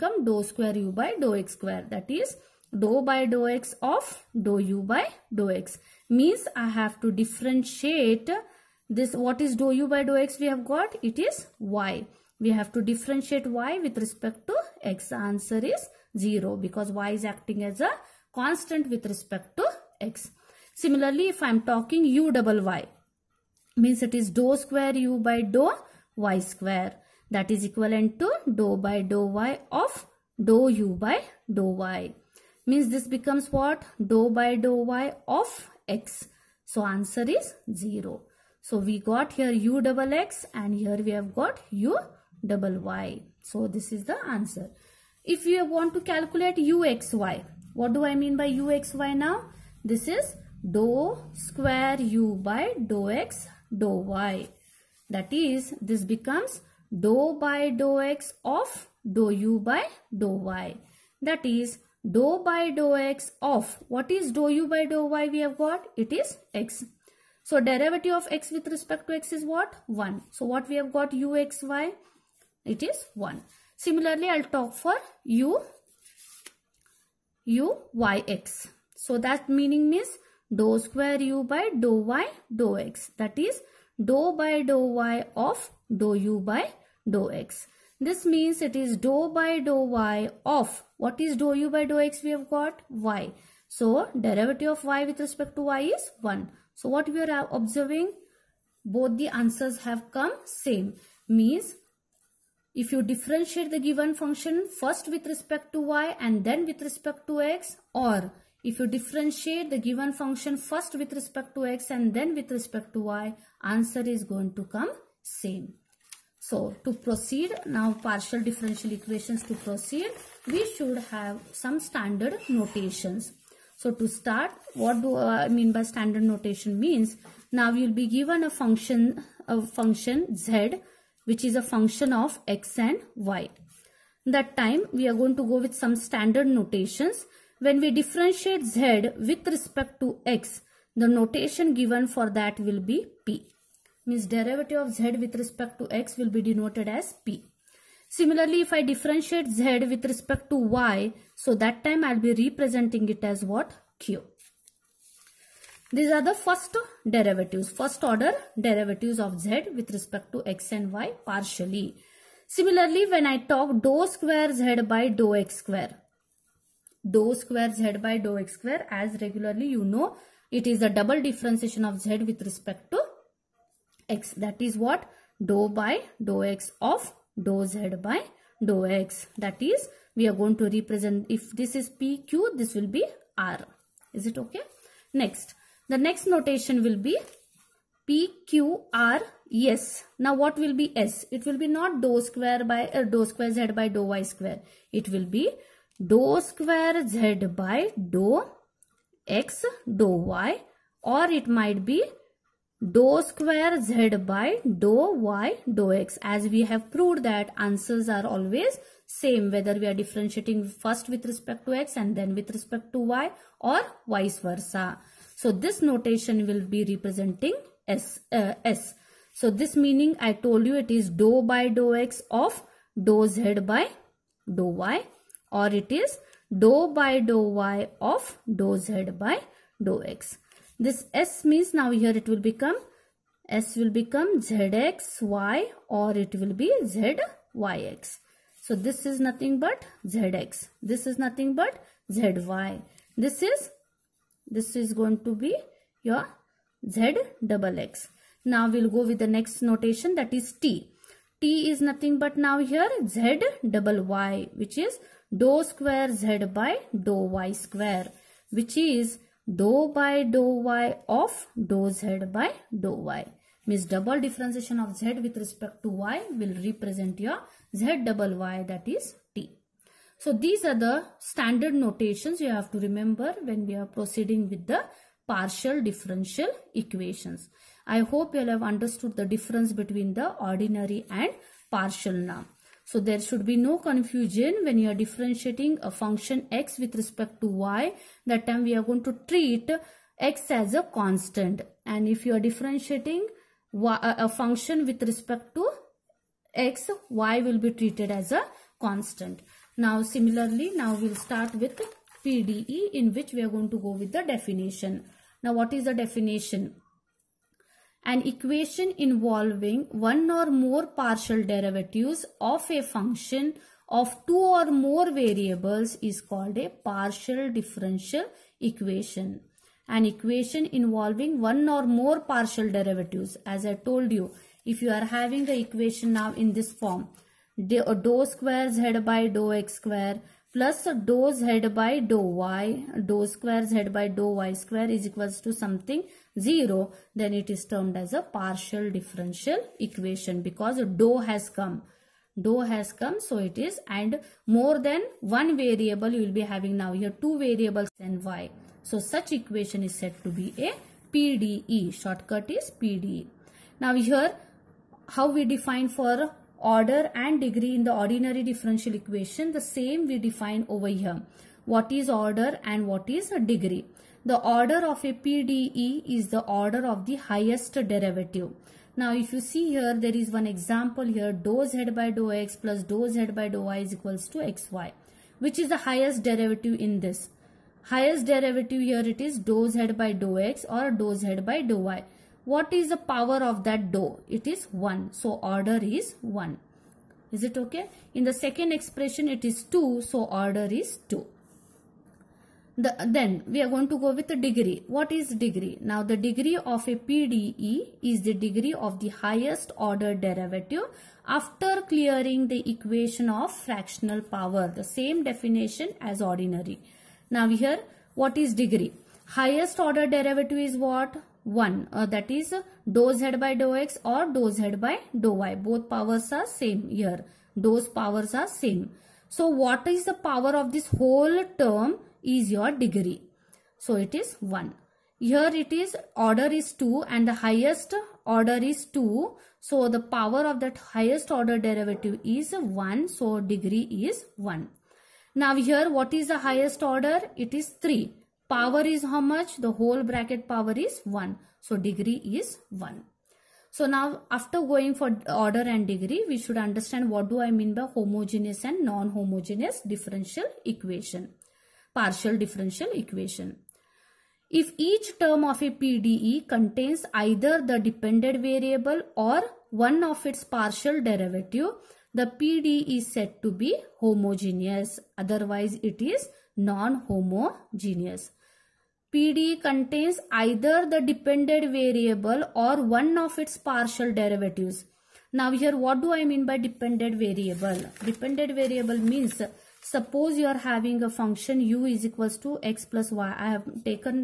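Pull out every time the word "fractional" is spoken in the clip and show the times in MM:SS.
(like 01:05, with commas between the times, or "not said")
06:43.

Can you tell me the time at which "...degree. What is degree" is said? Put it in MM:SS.
06:34.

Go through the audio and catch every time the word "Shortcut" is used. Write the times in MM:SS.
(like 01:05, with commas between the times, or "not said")
05:51.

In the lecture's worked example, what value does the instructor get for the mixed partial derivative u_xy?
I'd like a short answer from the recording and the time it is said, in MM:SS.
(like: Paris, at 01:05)
1, at 01:10.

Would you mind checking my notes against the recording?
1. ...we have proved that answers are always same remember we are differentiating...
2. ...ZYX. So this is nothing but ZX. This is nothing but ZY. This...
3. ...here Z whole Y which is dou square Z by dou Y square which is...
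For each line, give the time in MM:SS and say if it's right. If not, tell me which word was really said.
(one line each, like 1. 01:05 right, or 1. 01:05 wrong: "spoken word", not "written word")
1. 03:26 wrong: "whether", not "remember"
2. 03:56 right
3. 04:12 wrong: "double", not "whole".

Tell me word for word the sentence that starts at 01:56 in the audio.
So to proceed, now partial differential equations to proceed we should have some standard notations.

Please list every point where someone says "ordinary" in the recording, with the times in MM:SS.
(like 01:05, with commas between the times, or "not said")
04:40, 05:57, 06:46.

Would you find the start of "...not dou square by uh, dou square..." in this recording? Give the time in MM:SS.
03:11.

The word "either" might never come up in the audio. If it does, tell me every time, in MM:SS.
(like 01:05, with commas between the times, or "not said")
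07:37, 07:50.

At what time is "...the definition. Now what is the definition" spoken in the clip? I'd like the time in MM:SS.
05:04.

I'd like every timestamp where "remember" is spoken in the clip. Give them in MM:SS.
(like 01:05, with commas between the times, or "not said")
04:32.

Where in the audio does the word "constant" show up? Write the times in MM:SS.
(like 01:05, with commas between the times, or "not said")
00:18, 04:50, 04:58.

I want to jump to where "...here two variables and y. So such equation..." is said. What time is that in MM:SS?
05:46.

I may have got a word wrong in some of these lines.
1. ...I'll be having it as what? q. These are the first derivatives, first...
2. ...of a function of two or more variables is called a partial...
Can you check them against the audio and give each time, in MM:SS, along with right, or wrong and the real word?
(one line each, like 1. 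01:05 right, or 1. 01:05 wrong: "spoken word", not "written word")
1. 02:32 wrong: "representing", not "having"
2. 05:12 right.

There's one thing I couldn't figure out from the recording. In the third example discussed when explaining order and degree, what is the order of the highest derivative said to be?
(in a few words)
3.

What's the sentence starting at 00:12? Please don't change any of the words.
We have to differentiate y with respect to x.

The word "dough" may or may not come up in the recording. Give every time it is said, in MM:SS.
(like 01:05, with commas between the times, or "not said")
06:23.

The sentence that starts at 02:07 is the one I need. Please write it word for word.
Now you'll be given a function, a function z, which is a function of x and y.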